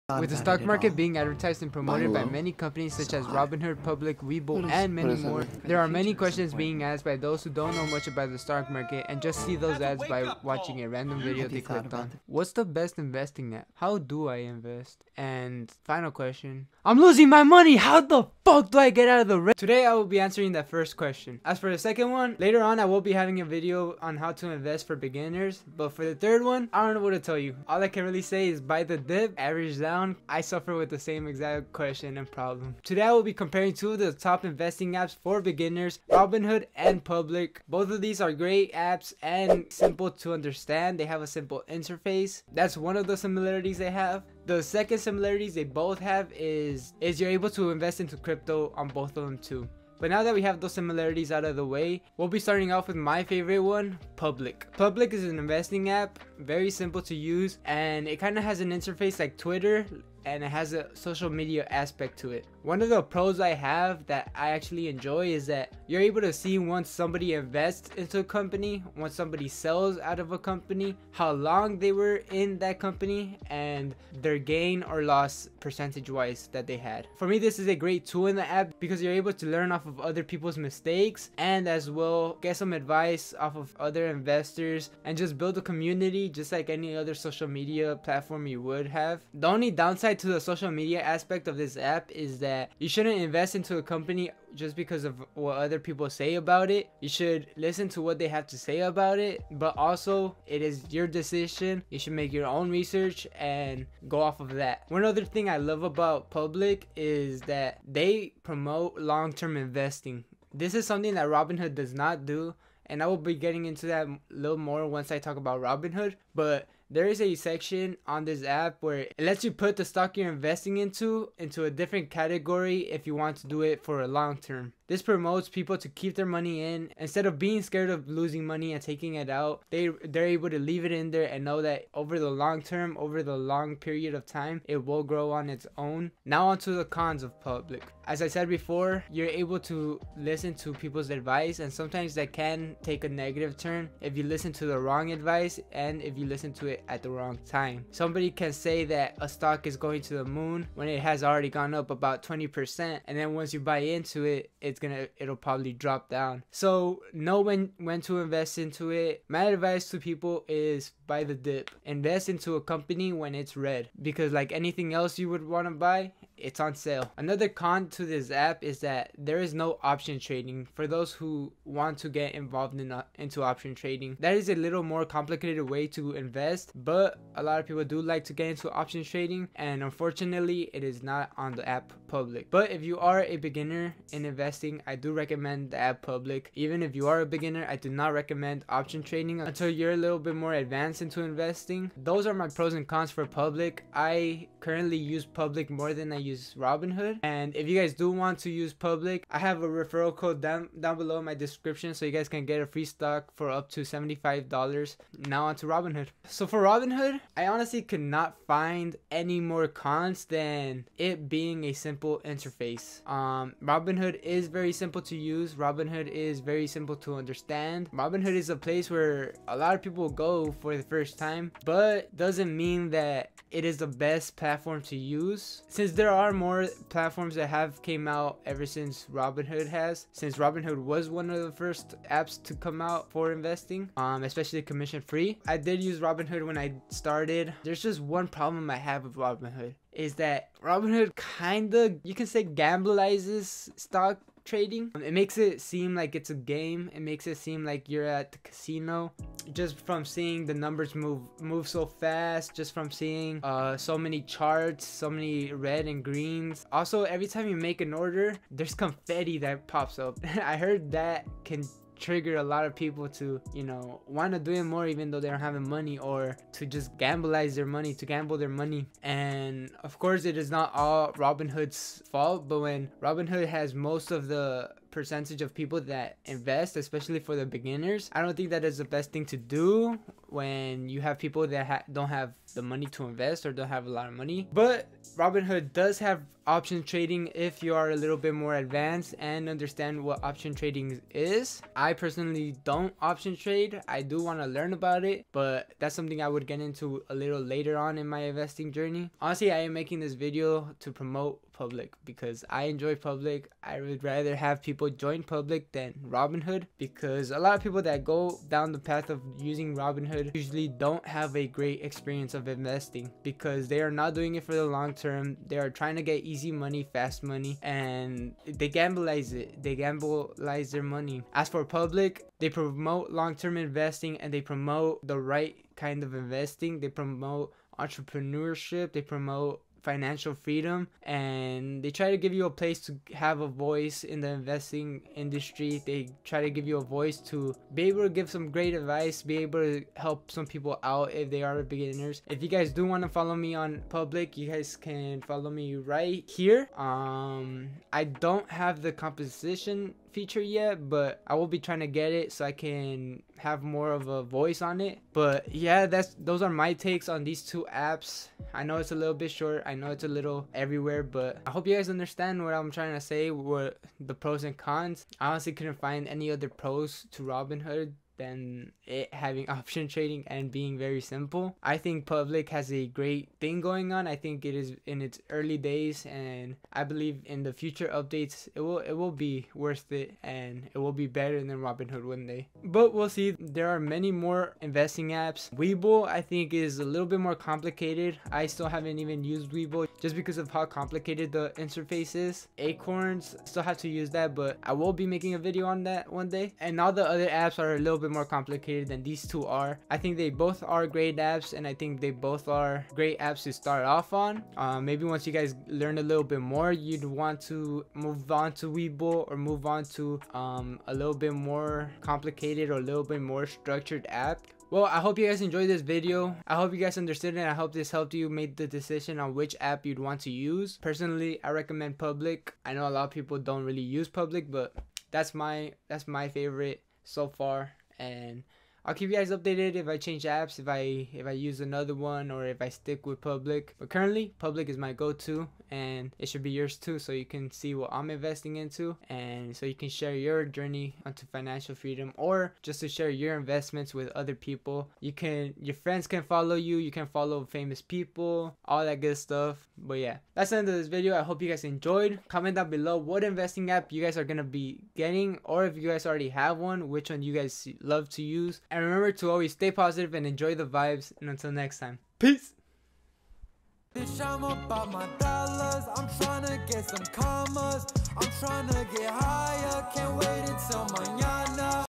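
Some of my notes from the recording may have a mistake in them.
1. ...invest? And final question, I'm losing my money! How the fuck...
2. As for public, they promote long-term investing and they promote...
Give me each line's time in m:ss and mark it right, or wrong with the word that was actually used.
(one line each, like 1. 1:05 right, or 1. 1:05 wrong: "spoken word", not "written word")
1. 0:14 right
2. 5:21 right.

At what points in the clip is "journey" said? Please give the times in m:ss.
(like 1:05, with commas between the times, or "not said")
4:58, 7:20.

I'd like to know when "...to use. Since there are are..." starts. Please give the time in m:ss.
3:44.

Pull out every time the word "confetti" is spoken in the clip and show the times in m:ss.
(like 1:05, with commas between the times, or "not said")
4:18.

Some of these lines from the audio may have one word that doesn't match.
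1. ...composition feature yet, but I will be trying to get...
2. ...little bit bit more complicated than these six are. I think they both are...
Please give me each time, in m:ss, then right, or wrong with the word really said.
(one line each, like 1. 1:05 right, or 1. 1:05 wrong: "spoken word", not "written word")
1. 5:48 right
2. 6:37 wrong: "two", not "six".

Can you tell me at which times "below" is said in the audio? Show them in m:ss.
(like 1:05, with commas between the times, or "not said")
3:20, 7:32.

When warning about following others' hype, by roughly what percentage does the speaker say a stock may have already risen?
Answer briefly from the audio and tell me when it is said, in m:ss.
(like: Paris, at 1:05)
20%, at 2:32.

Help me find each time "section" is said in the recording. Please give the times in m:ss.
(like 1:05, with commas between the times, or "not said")
1:57.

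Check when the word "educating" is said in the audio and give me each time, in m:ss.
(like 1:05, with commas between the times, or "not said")
not said.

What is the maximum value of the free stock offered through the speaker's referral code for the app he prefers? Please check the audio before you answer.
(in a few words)
$75.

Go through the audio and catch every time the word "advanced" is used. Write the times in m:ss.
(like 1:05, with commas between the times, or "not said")
3:10, 4:48.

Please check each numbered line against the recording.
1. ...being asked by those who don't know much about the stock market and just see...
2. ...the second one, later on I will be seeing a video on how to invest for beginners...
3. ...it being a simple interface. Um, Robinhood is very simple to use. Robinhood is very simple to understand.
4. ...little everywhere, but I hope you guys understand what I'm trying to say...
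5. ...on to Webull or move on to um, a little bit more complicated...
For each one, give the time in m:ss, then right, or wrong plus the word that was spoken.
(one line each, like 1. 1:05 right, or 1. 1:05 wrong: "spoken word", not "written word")
1. 0:06 right
2. 0:21 wrong: "having", not "seeing"
3. 3:30 right
4. 6:00 right
5. 6:48 right.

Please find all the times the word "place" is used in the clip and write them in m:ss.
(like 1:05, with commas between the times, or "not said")
3:38, 5:32.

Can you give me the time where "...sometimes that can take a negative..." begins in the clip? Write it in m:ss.
2:21.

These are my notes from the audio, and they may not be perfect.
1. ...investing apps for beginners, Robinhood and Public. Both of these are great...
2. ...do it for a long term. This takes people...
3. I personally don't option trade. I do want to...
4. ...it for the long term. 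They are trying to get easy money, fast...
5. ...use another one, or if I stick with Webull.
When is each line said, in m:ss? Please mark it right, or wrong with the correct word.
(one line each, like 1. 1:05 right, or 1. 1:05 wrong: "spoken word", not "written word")
1. 0:34 right
2. 2:03 wrong: "promotes", not "takes"
3. 4:51 right
4. 5:14 right
5. 7:11 wrong: "Public", not "Webull".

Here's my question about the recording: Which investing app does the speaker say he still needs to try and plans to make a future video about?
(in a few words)
Acorns.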